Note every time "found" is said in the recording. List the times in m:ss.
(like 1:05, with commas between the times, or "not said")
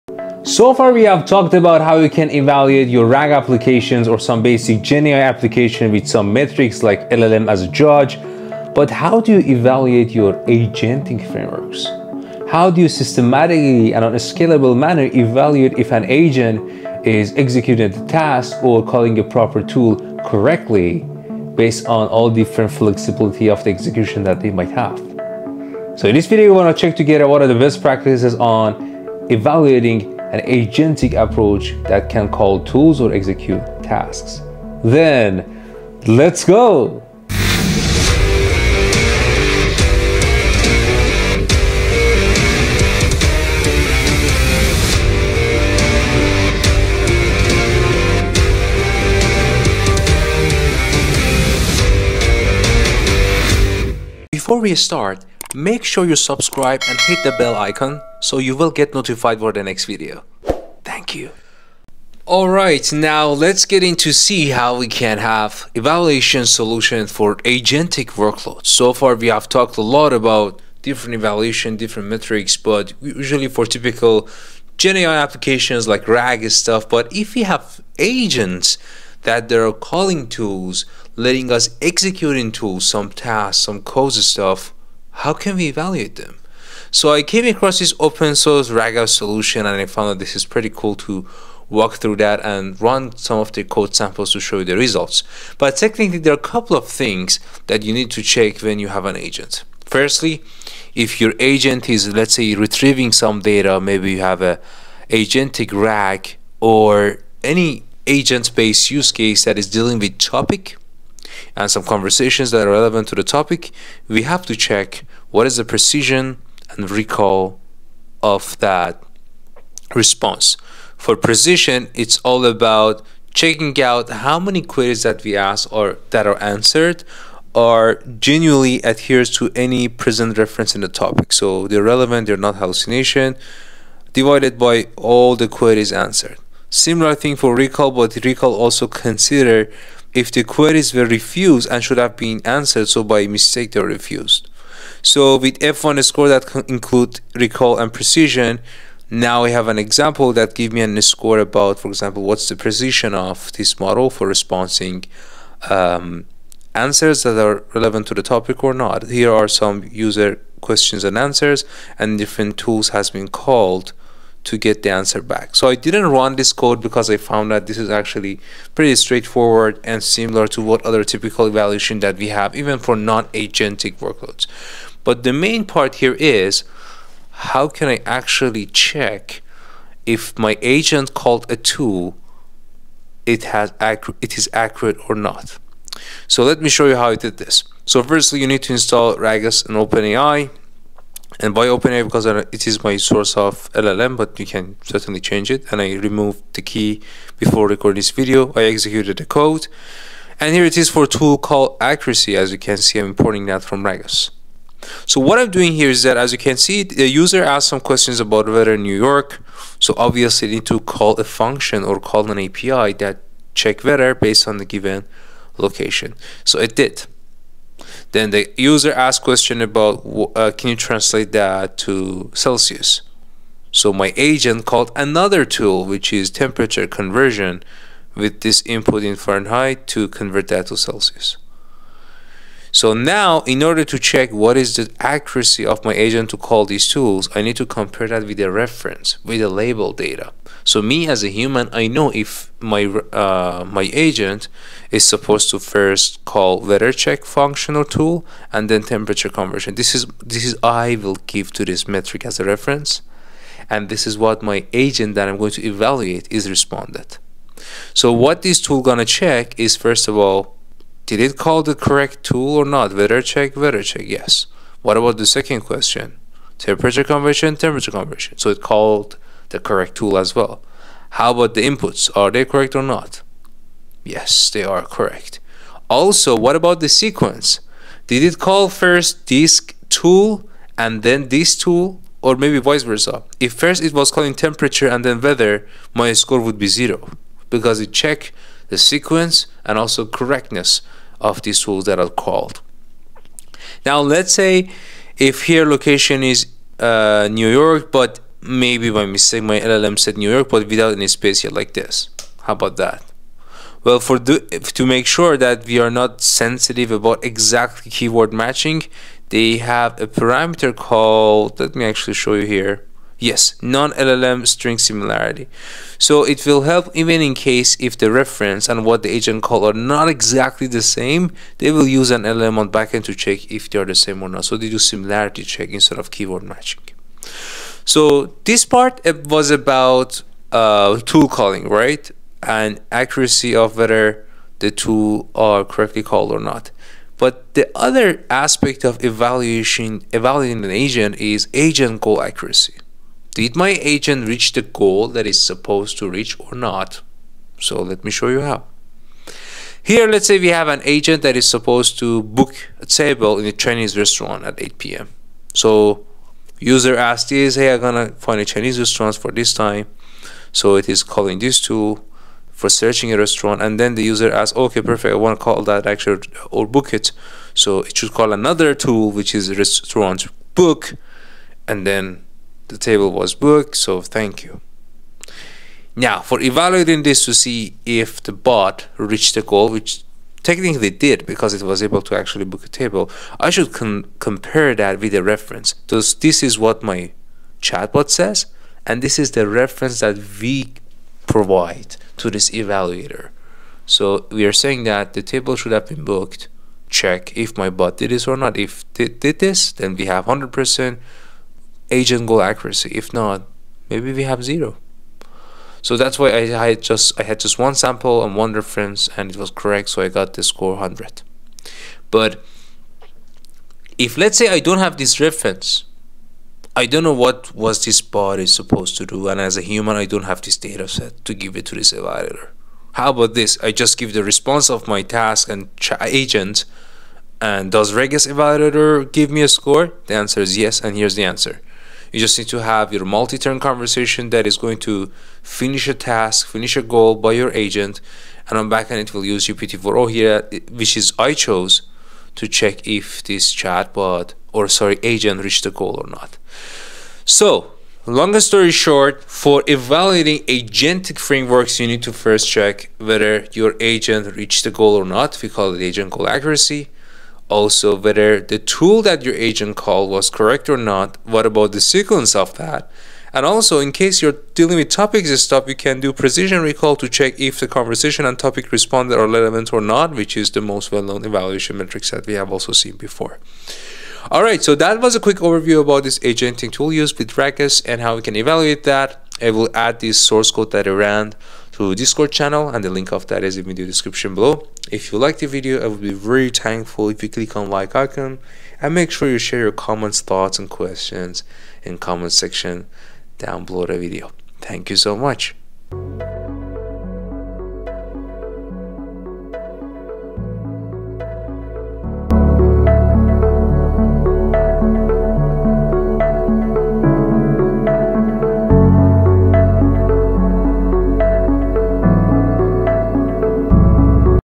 1:29, 2:47.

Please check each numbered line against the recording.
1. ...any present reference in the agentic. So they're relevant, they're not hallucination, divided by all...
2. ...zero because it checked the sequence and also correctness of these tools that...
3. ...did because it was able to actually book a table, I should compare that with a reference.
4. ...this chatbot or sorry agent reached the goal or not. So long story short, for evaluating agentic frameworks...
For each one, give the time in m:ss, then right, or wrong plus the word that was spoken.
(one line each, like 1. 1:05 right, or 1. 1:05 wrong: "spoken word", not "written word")
1. 2:09 wrong: "topic", not "agentic"
2. 4:46 right
3. 6:20 right
4. 7:23 right.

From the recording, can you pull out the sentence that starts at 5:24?
So they do similarity check instead of keyword matching.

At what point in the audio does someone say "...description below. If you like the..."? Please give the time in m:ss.
8:03.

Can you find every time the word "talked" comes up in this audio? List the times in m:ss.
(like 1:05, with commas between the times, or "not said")
0:01, 1:09.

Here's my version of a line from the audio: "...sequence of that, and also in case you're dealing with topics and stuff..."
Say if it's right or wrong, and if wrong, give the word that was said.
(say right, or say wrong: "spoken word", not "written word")
right.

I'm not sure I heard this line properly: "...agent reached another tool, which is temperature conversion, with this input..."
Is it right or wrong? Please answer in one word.
wrong.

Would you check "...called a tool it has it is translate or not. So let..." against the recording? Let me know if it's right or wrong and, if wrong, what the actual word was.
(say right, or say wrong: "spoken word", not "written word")
wrong: "accurate", not "translate".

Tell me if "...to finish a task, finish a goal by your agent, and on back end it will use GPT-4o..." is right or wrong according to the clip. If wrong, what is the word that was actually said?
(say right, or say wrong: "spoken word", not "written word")
right.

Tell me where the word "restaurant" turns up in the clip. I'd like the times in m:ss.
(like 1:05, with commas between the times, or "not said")
5:53, 5:58, 6:03, 6:09.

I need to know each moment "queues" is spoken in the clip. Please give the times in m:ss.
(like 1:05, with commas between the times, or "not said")
not said.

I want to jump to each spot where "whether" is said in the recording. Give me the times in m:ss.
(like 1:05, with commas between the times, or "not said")
5:33, 7:32, 7:37.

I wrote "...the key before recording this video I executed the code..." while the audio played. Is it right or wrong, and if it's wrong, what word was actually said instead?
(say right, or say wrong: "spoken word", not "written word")
right.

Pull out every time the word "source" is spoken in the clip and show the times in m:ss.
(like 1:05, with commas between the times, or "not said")
1:28, 3:12, 8:00.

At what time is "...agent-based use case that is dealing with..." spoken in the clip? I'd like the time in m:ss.
1:48.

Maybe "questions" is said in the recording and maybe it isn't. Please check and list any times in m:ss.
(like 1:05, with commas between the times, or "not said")
2:40, 3:27, 3:39, 4:25, 8:10.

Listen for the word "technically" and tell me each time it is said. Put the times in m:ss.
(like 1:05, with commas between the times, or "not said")
1:35, 6:20.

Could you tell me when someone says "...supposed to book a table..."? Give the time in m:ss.
5:51.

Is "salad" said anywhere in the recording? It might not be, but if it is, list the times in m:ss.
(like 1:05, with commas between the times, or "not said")
not said.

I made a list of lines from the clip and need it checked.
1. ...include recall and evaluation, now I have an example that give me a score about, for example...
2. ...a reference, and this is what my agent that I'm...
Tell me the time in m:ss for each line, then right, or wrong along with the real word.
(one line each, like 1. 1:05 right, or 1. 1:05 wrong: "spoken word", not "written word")
1. 2:26 wrong: "precision", not "evaluation"
2. 4:12 right.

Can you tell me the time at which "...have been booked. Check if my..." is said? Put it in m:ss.
6:35.